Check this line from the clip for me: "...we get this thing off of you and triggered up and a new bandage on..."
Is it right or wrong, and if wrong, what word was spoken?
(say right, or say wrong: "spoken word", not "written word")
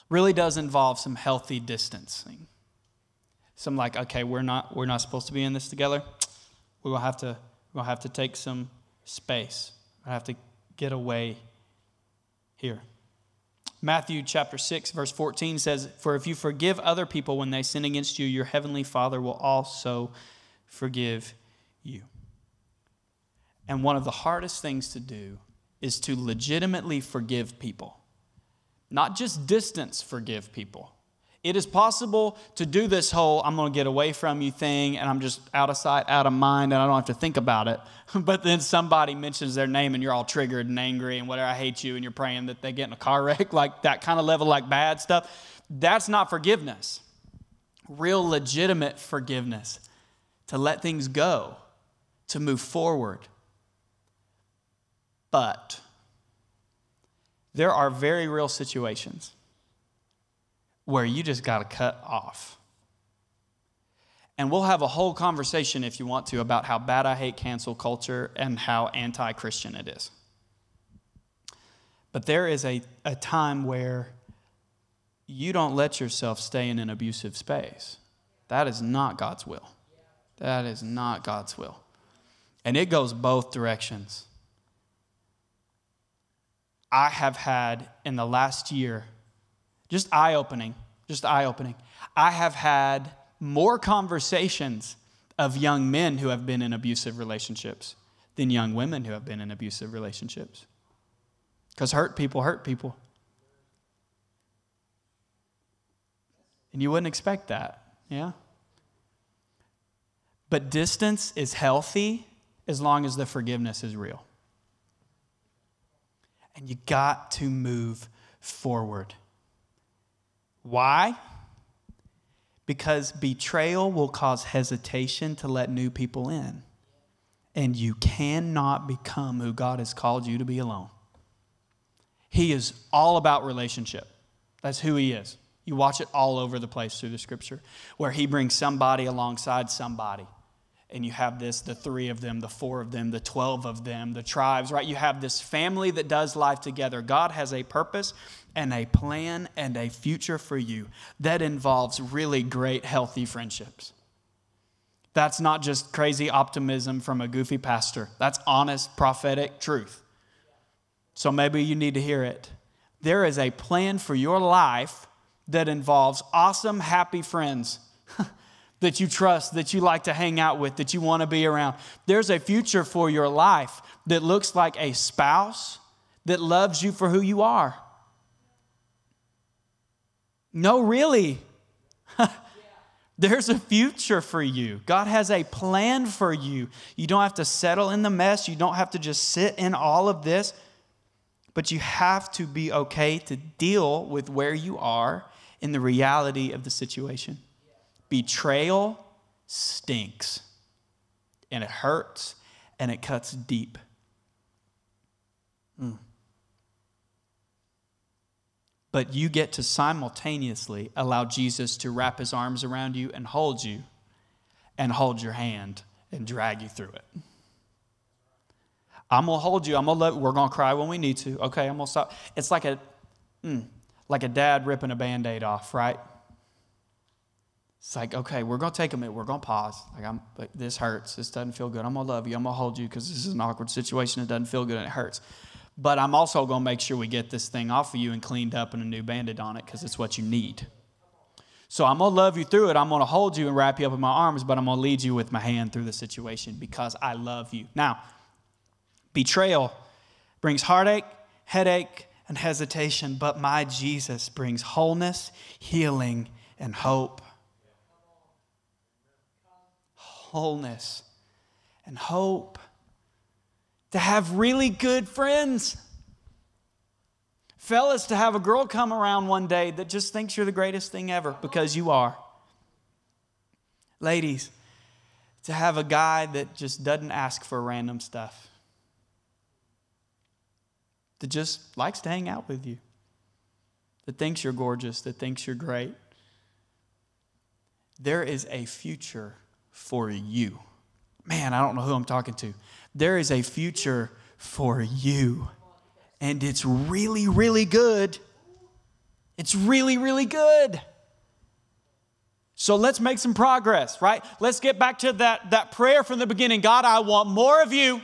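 wrong: "cleaned", not "triggered".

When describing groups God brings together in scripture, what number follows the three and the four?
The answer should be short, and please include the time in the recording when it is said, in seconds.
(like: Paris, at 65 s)
12, at 143 s.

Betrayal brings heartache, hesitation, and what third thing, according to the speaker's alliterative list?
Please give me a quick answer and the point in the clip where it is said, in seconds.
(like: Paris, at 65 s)
headache, at 251 s.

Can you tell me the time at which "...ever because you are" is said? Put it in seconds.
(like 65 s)
271 s.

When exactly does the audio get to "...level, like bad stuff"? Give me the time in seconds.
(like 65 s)
44 s.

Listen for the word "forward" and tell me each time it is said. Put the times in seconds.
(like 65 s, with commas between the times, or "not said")
52 s, 118 s.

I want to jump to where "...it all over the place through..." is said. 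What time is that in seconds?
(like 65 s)
135 s.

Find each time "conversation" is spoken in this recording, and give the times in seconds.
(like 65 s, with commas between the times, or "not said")
65 s, 93 s.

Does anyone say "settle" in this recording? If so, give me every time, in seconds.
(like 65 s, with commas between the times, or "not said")
187 s.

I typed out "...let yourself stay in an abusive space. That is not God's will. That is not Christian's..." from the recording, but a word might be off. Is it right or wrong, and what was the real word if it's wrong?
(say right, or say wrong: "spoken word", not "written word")
wrong: "God", not "Christian".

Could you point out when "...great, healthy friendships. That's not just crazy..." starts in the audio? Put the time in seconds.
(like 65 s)
152 s.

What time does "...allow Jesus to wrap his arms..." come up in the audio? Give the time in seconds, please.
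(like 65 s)
210 s.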